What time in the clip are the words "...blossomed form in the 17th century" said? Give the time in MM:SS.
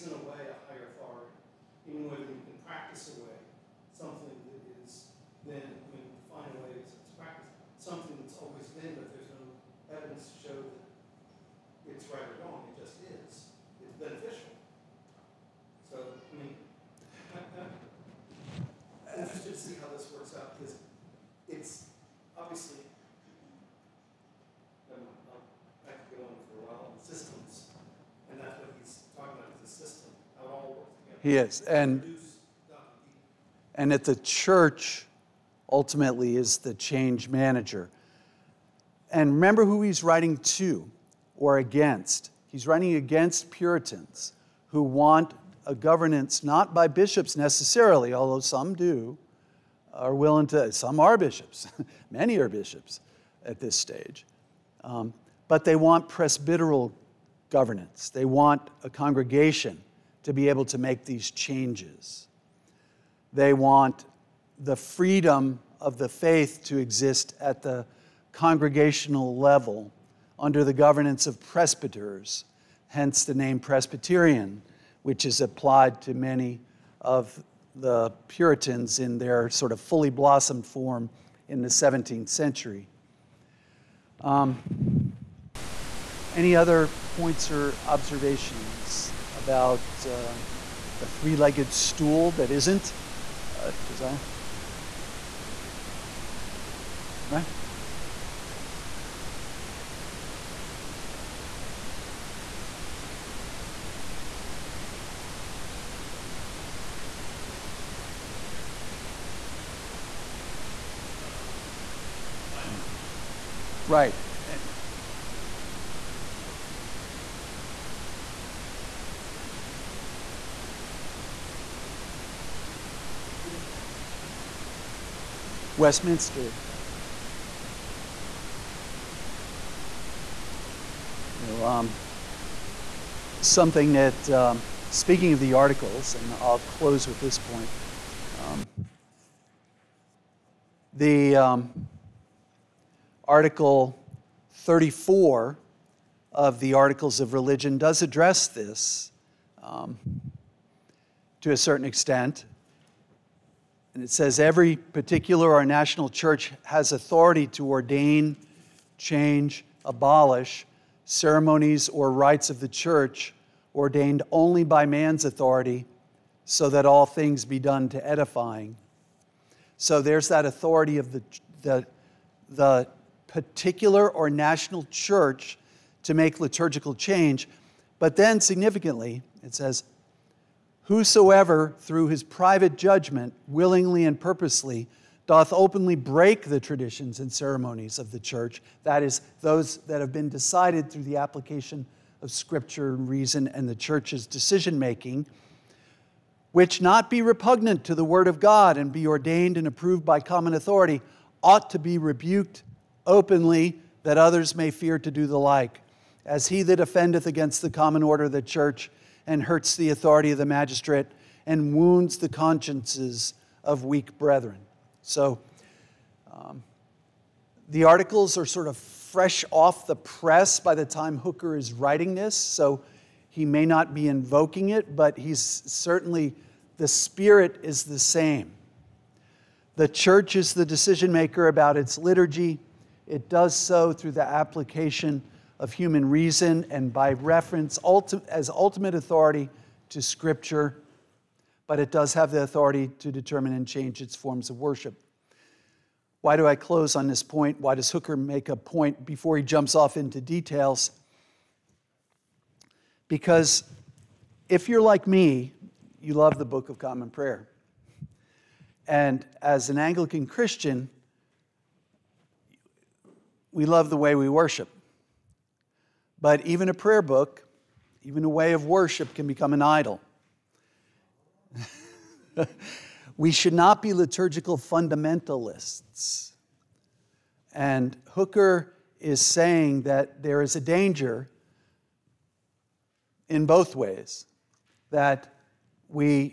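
01:20.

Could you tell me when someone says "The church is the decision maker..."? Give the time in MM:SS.
03:49.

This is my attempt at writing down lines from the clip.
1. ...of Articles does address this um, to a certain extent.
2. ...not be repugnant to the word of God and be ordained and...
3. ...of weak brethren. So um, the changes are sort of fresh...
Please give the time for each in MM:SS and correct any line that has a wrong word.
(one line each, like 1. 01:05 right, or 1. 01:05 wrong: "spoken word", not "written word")
1. 02:27 wrong: "Religion", not "Articles"
2. 03:16 right
3. 03:33 wrong: "articles", not "changes".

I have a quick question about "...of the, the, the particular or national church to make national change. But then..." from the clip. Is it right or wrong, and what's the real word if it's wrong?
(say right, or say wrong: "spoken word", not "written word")
wrong: "liturgical", not "national".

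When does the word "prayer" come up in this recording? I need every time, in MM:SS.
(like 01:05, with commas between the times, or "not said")
04:17, 04:26.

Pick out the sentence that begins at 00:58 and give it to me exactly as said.
They want a congregation to be able to make these changes.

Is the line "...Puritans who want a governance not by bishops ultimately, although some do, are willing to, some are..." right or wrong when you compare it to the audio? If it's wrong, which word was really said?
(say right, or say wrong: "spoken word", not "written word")
wrong: "necessarily", not "ultimately".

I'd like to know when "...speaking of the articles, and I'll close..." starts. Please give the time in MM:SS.
02:14.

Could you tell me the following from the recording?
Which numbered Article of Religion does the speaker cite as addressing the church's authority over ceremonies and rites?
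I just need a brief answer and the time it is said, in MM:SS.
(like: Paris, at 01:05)
Article 34, at 02:23.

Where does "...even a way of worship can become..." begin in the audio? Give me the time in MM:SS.
04:28.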